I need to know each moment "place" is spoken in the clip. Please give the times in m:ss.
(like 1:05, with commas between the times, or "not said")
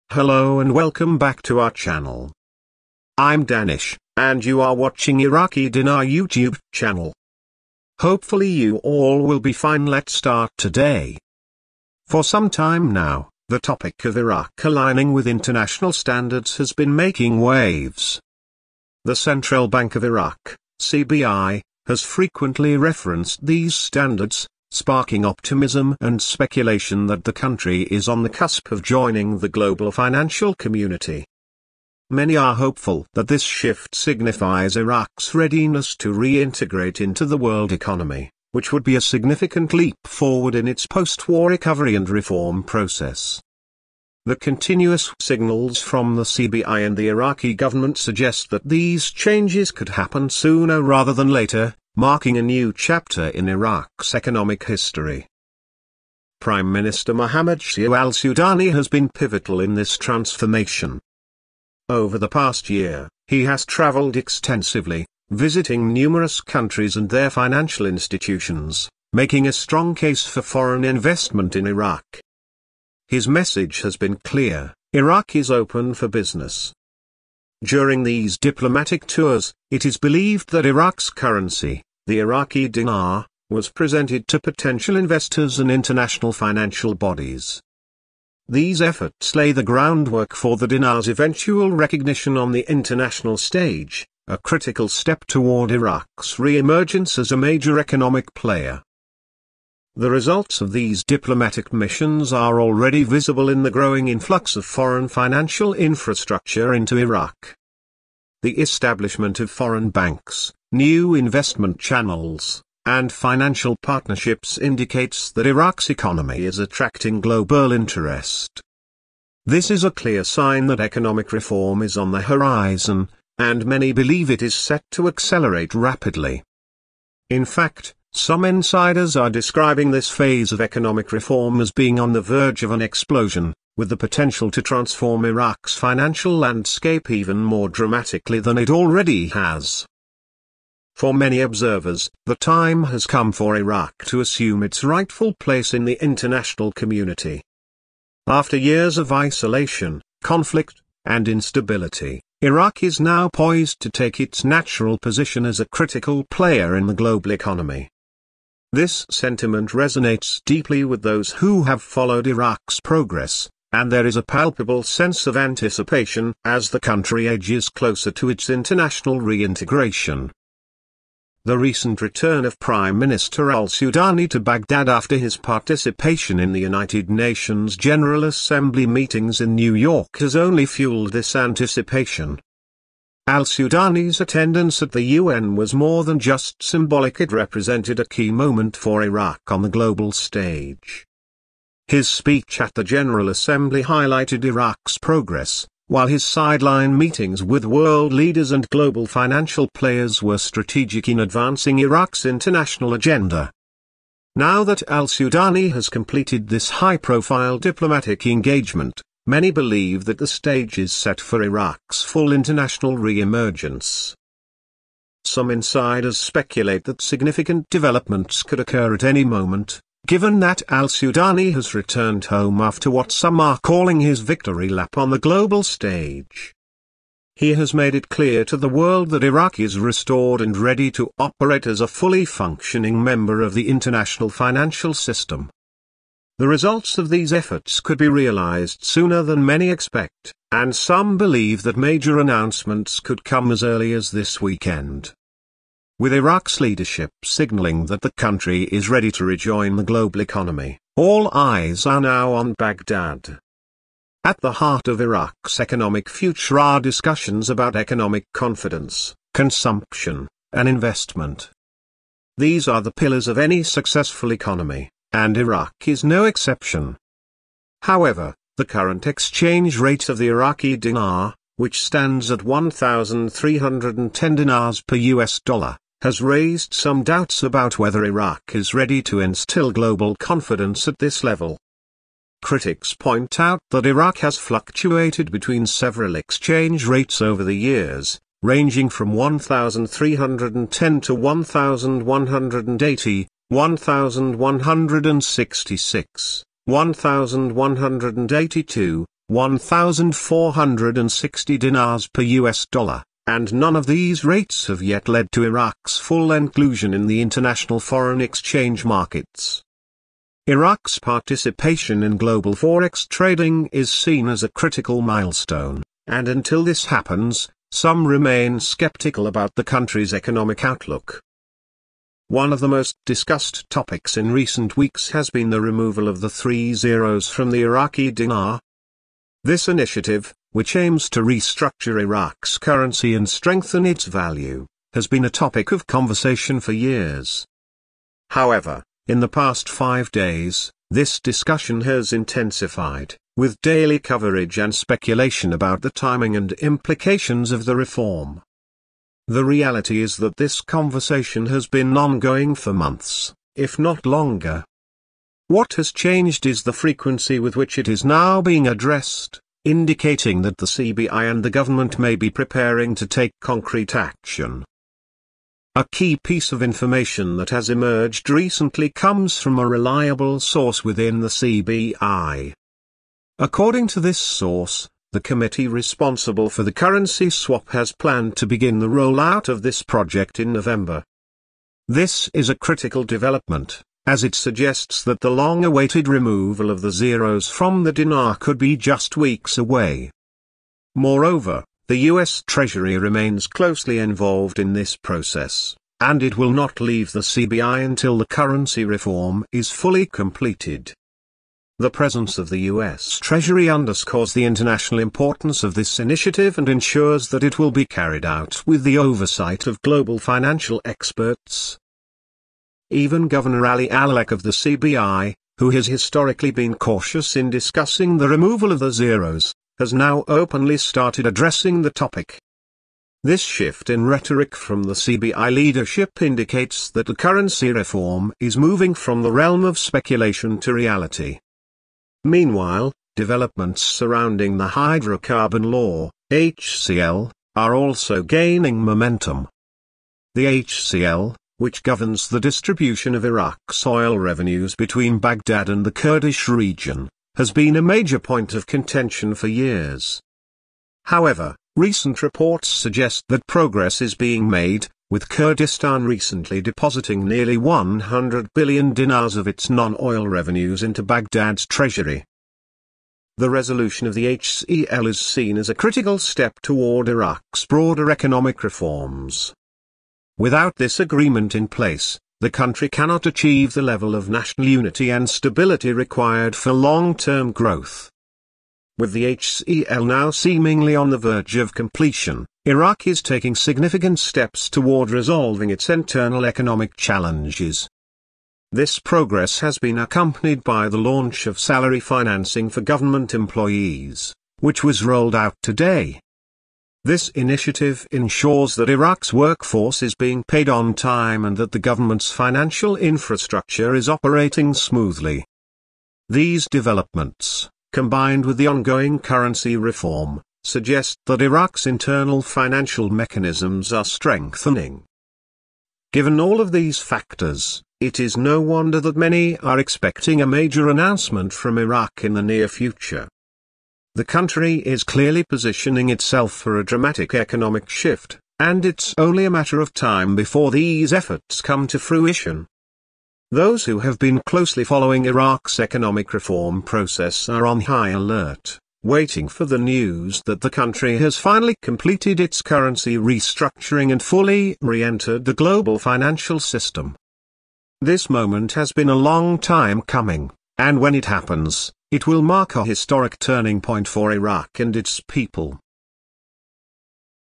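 2:25, 7:51.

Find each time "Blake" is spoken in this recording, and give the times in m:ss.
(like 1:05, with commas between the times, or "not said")
not said.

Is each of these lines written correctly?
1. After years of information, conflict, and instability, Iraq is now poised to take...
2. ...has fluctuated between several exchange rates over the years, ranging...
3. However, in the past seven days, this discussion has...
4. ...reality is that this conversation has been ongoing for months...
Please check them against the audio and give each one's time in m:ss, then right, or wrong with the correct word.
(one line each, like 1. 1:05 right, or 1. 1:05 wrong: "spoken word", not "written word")
1. 2:28 wrong: "isolation", not "information"
2. 4:44 right
3. 5:38 wrong: "five", not "seven"
4. 5:49 right.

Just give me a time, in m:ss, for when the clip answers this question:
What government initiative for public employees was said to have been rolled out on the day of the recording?
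8:11.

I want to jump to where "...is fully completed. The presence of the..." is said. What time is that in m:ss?
6:39.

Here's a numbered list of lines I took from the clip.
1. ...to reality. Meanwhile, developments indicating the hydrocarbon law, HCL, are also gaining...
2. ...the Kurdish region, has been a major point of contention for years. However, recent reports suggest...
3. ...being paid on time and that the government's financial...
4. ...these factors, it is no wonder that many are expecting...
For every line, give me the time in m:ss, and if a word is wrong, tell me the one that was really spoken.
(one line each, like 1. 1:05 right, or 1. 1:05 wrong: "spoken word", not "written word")
1. 7:10 wrong: "surrounding", not "indicating"
2. 7:25 right
3. 8:20 right
4. 8:36 right.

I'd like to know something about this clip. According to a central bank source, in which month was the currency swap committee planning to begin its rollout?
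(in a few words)
November.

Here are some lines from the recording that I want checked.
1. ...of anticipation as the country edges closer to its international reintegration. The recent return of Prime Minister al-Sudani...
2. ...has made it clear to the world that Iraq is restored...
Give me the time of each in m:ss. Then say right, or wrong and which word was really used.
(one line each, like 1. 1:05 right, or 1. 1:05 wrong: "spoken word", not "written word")
1. 2:45 right
2. 3:47 right.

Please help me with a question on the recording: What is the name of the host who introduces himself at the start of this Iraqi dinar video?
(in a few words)
Danish.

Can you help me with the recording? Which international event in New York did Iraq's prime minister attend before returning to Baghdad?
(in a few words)
United Nations General Assembly.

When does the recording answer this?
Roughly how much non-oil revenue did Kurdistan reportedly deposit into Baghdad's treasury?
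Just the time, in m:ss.
7:37.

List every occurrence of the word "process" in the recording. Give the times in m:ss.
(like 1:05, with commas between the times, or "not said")
0:42, 6:34, 8:56.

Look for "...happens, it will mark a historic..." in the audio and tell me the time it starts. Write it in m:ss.
9:11.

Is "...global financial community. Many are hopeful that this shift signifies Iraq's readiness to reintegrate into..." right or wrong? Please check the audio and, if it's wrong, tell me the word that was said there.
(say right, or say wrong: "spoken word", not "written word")
right.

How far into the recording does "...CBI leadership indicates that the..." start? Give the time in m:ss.
7:04.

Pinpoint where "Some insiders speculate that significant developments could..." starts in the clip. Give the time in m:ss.
3:35.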